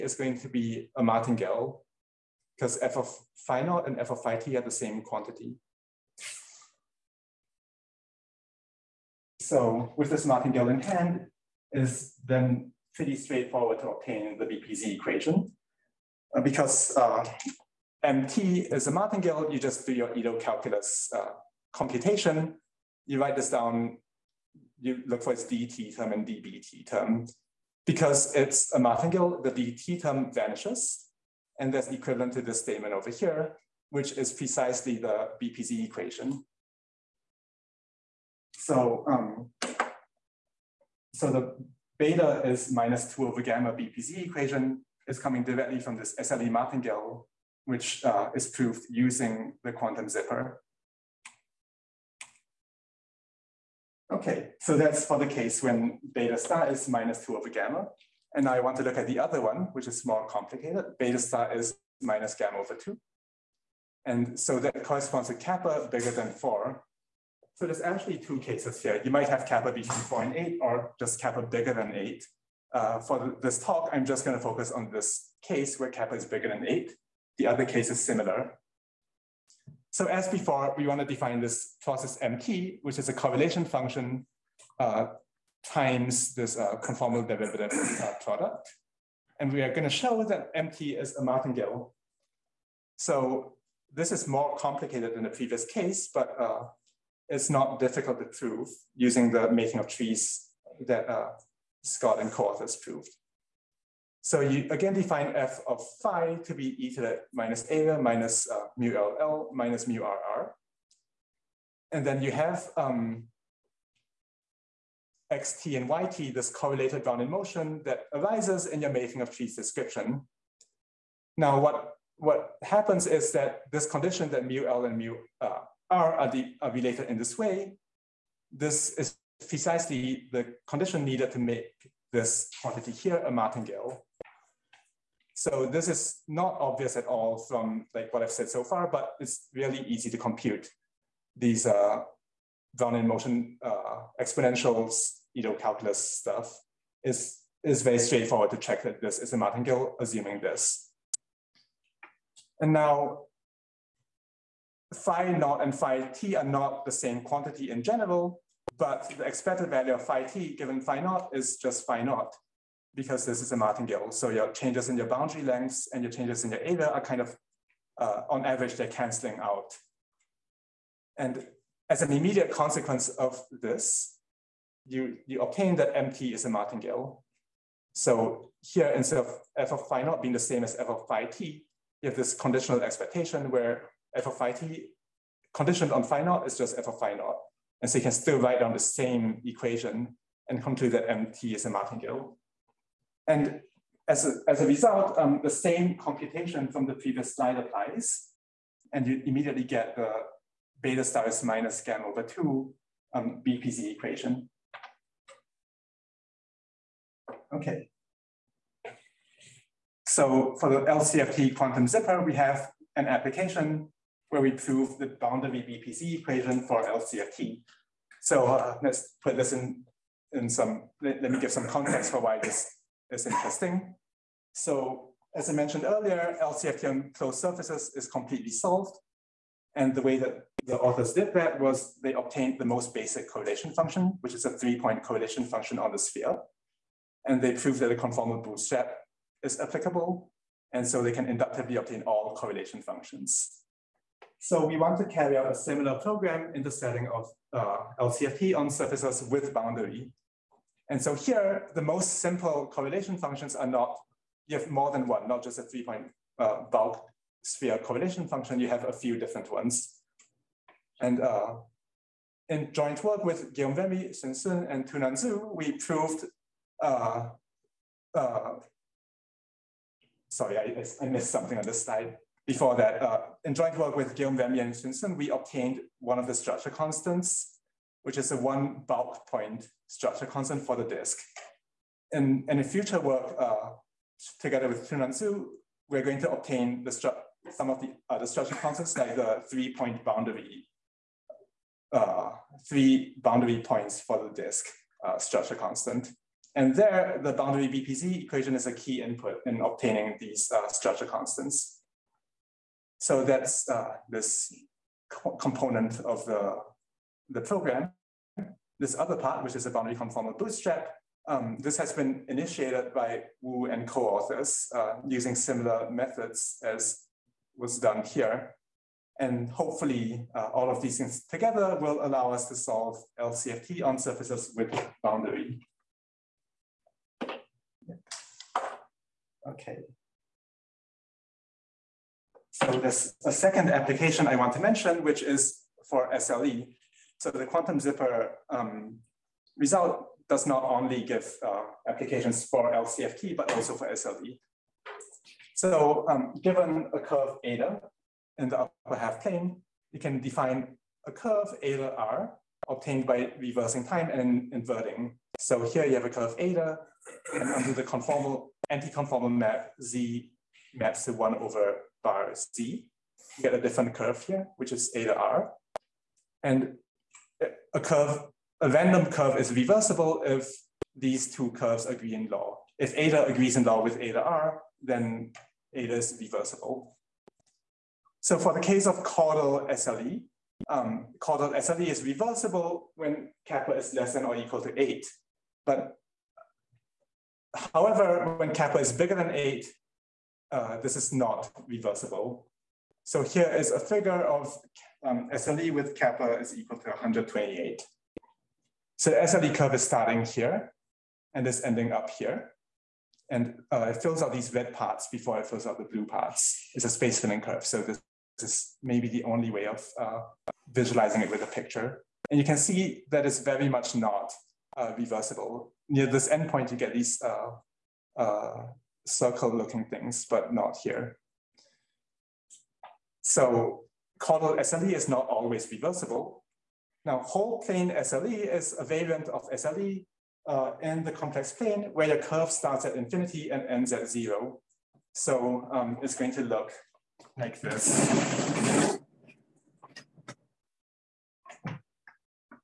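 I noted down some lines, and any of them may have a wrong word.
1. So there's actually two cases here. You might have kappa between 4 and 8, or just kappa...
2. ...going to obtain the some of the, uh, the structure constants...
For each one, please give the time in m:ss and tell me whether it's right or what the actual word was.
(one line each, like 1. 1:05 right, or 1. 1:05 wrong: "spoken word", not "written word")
1. 1:07 right
2. 4:46 right.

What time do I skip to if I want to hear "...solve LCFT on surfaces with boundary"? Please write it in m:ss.
5:22.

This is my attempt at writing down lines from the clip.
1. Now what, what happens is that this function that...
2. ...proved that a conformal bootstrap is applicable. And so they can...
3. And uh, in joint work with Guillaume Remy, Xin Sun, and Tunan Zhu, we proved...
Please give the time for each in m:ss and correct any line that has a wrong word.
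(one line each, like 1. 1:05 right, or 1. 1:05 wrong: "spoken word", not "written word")
1. 2:01 wrong: "condition", not "function"
2. 3:57 right
3. 4:21 right.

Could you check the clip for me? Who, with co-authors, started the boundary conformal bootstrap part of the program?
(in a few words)
Wu.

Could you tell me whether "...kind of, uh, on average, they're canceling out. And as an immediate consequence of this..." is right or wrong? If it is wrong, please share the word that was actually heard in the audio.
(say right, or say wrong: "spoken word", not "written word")
right.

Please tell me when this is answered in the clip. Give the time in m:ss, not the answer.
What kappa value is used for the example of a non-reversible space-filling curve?
6:36.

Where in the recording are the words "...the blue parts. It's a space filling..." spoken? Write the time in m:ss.
6:45.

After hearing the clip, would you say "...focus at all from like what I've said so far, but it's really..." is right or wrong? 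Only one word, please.
wrong.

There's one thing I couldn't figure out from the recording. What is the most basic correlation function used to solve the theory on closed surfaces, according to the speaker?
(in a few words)
three-point correlation function on the sphere.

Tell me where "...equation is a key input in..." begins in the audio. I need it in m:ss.
4:58.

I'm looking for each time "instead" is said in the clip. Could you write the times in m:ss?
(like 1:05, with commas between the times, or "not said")
2:58.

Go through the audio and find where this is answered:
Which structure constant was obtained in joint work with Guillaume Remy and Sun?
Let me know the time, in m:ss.
4:38.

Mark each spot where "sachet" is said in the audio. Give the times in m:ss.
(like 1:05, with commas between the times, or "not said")
not said.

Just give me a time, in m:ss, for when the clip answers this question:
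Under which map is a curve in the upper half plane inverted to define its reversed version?
5:59.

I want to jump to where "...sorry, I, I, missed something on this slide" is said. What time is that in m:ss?
4:30.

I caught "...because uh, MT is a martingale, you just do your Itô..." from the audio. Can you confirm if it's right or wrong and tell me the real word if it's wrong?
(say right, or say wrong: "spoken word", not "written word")
right.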